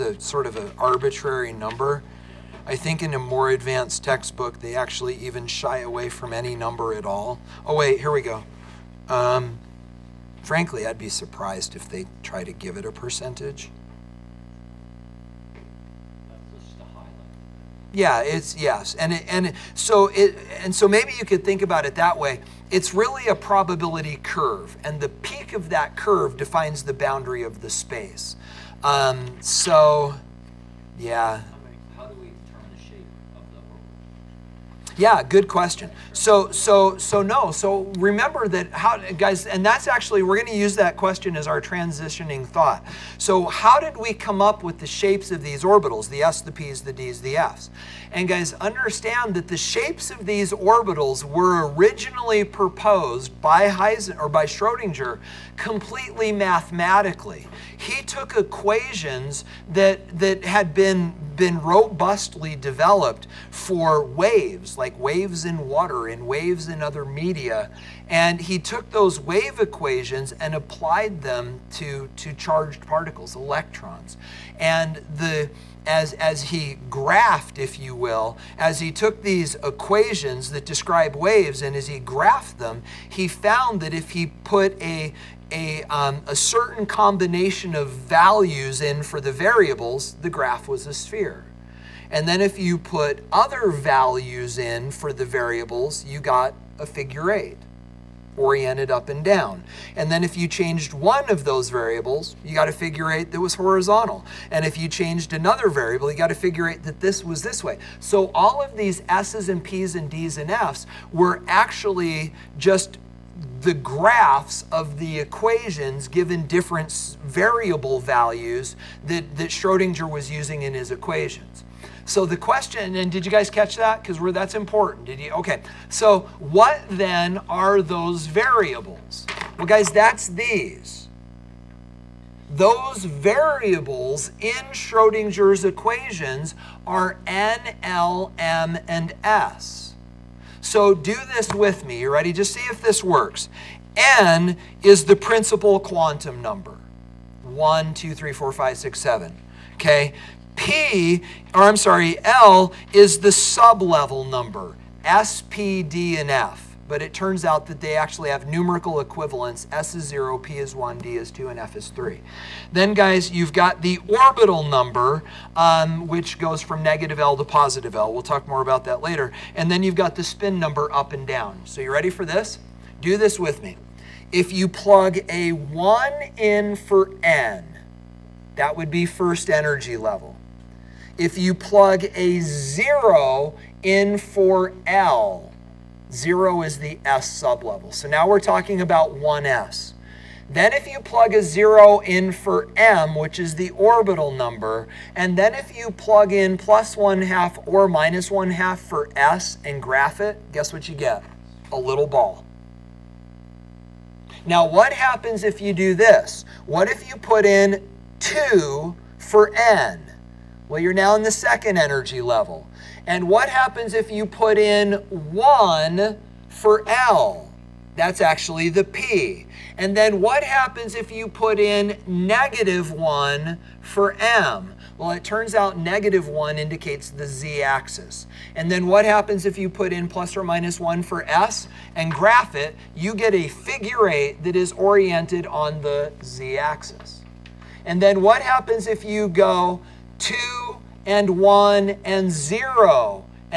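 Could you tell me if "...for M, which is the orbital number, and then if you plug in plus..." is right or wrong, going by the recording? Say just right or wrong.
right.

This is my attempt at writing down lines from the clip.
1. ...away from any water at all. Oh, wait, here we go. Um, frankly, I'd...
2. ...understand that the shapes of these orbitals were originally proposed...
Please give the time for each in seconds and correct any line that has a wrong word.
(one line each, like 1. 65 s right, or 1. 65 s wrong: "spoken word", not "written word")
1. 5 s wrong: "number", not "water"
2. 48 s right.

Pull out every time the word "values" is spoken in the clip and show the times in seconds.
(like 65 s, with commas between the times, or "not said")
87 s, 93 s, 117 s.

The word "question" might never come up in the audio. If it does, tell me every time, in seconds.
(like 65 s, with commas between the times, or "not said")
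35 s, 40 s, 122 s.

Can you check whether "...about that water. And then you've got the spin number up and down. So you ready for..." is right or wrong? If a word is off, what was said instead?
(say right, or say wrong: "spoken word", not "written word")
wrong: "later", not "water".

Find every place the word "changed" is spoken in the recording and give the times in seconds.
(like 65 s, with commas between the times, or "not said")
100 s, 104 s.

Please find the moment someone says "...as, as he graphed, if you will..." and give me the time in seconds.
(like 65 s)
75 s.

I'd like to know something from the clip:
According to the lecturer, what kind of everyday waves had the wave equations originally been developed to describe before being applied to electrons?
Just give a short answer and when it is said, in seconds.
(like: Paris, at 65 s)
waves in water, at 64 s.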